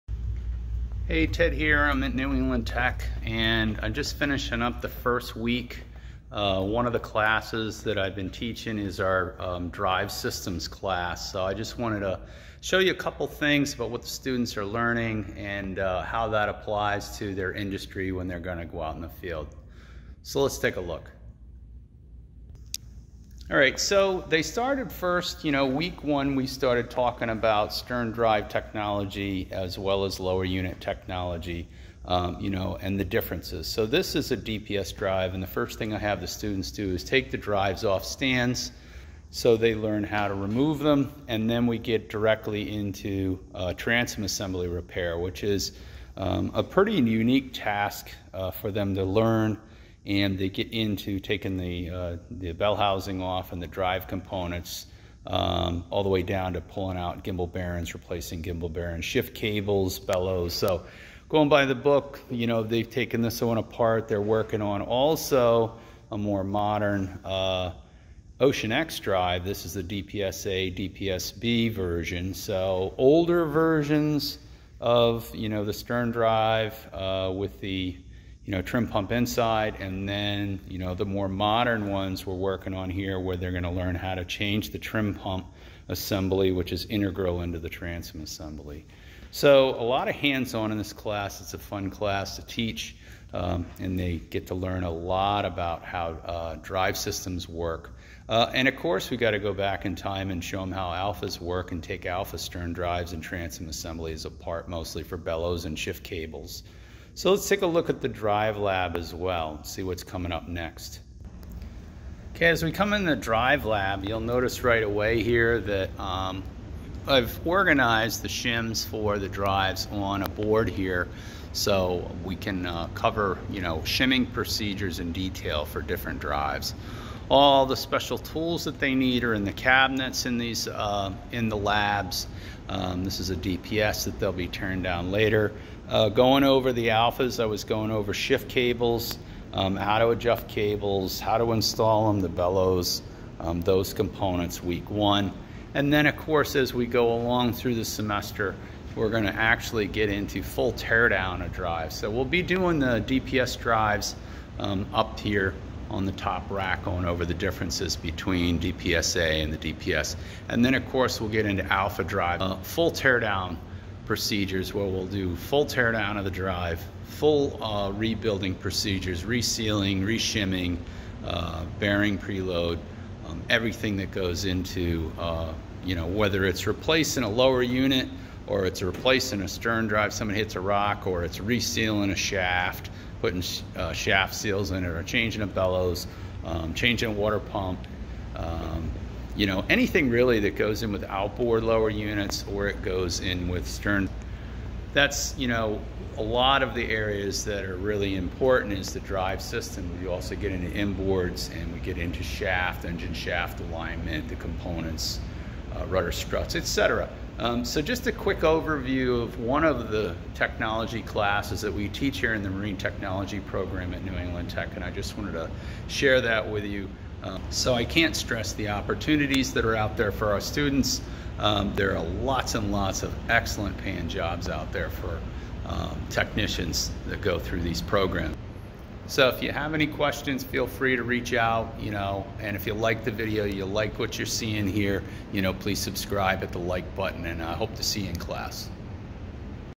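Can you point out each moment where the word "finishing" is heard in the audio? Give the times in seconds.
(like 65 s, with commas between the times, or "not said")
4 s.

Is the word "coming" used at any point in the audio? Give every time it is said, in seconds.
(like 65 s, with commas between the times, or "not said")
110 s.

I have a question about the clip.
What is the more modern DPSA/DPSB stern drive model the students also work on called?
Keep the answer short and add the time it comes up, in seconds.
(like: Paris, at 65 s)
Ocean X, at 68 s.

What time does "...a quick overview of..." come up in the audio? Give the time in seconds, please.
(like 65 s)
208 s.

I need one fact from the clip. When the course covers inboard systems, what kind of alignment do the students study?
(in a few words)
engine shaft alignment.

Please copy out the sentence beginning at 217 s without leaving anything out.
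Um, so I can't stress the opportunities that are out there for our students.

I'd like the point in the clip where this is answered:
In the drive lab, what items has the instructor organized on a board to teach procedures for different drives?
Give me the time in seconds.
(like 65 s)
118 s.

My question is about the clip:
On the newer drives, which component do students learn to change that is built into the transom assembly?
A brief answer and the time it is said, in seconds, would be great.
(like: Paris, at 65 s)
trim pump assembly, at 84 s.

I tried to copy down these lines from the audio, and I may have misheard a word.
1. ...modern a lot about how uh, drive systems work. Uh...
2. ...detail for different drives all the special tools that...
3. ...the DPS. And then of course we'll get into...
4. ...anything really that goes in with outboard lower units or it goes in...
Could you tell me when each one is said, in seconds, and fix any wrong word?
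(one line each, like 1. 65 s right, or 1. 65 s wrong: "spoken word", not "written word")
1. 94 s wrong: "learn", not "modern"
2. 125 s right
3. 159 s right
4. 189 s right.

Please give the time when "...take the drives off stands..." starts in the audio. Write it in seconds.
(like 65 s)
37 s.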